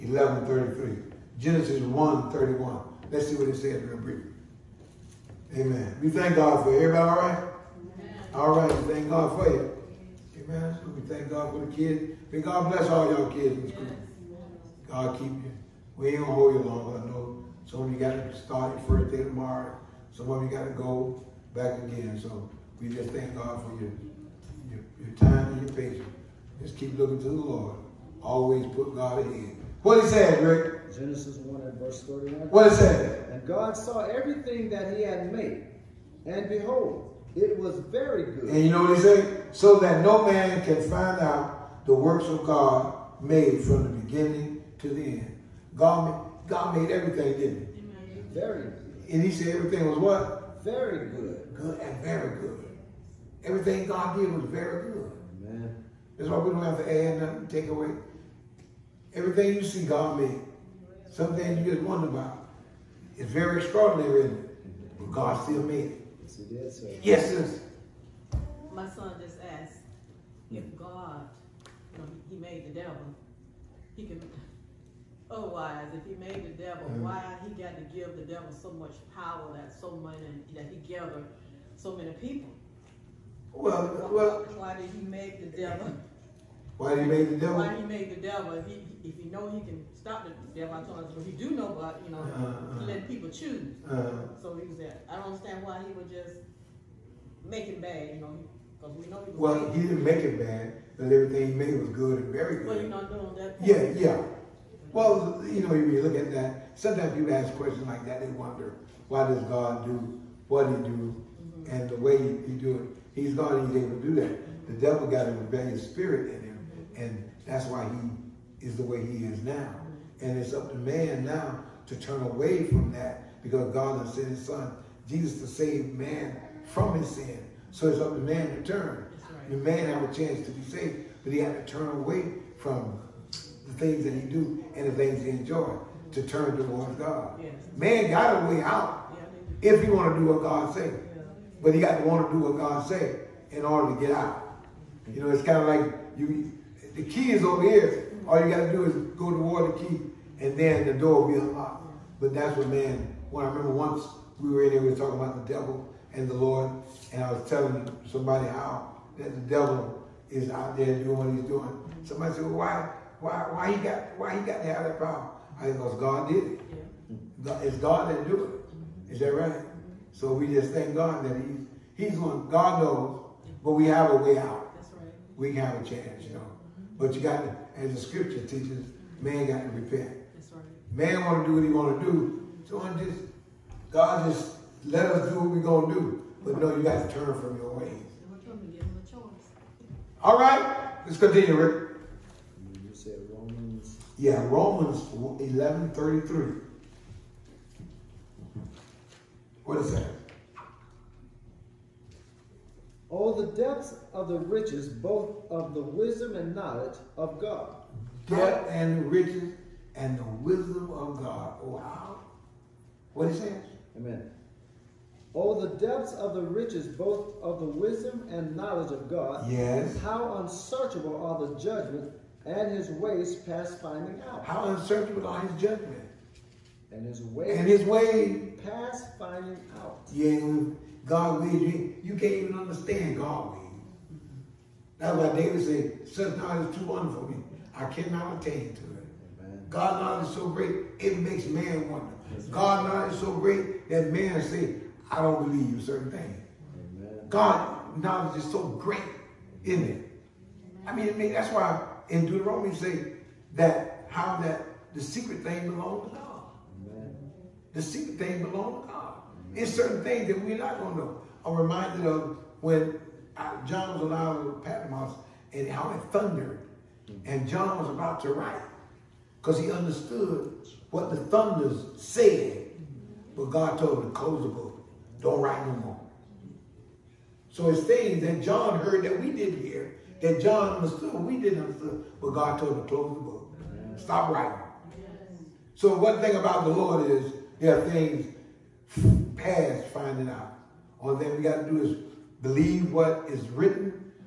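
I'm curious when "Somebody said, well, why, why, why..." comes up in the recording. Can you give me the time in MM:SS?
02:42.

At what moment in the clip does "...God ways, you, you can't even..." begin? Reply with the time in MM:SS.
03:51.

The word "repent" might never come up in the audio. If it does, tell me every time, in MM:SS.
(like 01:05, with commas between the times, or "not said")
02:59.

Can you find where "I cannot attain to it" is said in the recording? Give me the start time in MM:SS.
03:57.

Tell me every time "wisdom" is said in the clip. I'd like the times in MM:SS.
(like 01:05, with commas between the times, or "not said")
03:25, 03:30, 03:37.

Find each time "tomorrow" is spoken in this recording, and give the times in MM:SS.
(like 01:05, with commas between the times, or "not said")
00:19.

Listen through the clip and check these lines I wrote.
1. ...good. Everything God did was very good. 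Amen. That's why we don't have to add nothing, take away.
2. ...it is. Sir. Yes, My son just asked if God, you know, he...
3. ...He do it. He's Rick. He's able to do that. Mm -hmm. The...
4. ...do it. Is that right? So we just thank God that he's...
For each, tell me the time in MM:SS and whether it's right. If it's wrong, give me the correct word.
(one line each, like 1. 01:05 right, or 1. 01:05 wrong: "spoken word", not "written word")
1. 00:52 right
2. 01:06 right
3. 01:52 wrong: "God", not "Rick"
4. 02:48 right.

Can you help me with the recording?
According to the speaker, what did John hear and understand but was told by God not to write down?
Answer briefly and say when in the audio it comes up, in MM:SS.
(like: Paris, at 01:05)
The thunders, at 04:31.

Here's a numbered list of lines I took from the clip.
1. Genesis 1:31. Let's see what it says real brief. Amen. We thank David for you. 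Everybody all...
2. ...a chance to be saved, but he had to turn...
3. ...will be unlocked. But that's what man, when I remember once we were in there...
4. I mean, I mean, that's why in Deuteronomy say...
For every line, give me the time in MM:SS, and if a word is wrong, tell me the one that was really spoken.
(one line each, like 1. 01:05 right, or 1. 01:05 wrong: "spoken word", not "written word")
1. 00:01 wrong: "God", not "David"
2. 02:10 right
3. 02:31 right
4. 04:10 right.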